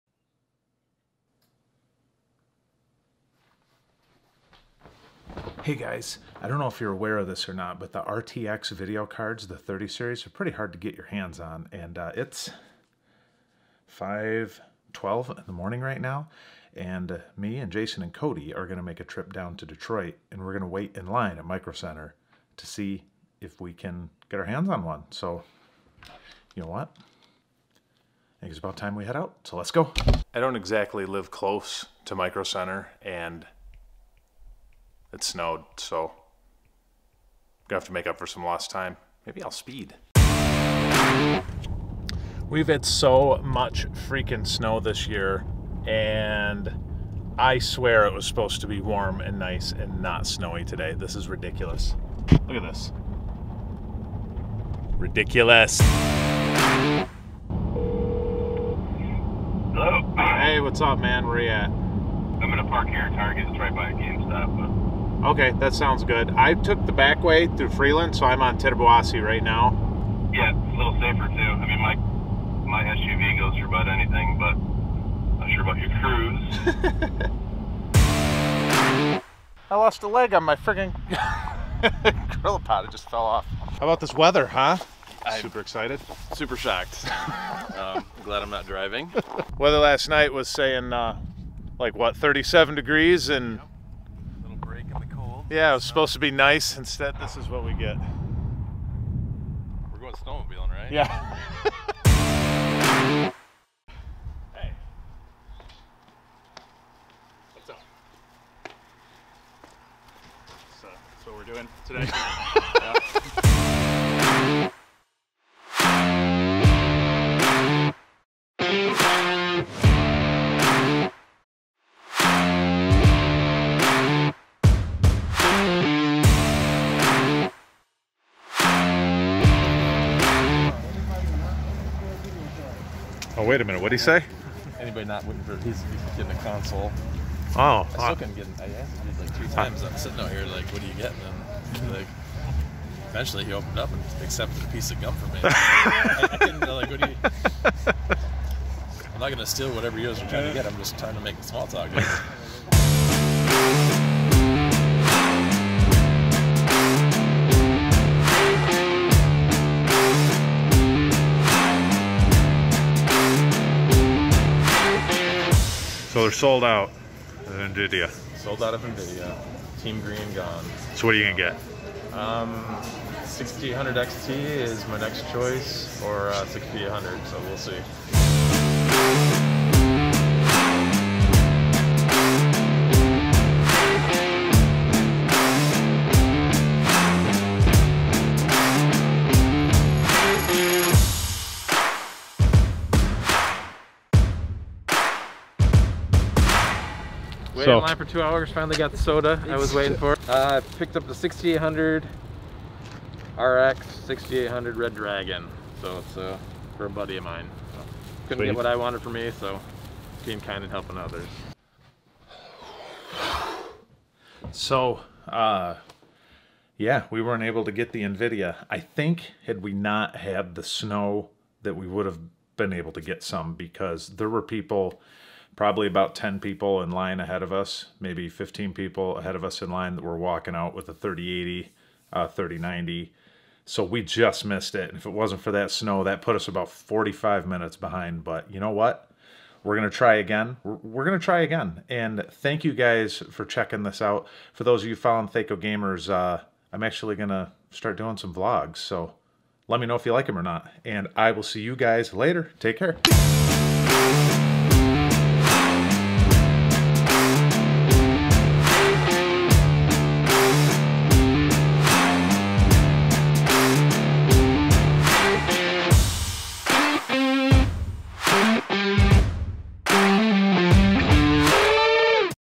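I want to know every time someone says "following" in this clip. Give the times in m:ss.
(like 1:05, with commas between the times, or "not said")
4:04.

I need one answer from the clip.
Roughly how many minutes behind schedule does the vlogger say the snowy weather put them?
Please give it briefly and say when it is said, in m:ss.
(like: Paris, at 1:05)
45 minutes, at 3:56.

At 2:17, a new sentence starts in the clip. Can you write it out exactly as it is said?
I uh, still uh, couldn't get I asked him like three times.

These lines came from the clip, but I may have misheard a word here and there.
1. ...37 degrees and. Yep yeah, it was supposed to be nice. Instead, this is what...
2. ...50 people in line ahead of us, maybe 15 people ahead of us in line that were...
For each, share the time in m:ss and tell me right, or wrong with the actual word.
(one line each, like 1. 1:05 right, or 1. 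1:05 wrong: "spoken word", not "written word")
1. 1:32 right
2. 3:46 wrong: "10", not "50".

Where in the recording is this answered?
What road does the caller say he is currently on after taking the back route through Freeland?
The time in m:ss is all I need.
1:08.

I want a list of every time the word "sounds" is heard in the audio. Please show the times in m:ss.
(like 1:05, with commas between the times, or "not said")
1:05.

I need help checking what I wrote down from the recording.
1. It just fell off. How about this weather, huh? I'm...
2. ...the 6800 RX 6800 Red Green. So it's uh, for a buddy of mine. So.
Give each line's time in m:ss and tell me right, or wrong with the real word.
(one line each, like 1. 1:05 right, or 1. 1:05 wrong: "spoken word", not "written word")
1. 1:22 right
2. 3:21 wrong: "Dragon", not "Green".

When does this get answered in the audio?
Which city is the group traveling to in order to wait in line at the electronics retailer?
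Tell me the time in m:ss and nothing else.
0:19.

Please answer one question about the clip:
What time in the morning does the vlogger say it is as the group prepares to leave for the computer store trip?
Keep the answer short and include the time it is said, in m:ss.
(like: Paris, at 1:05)
5:12, at 0:13.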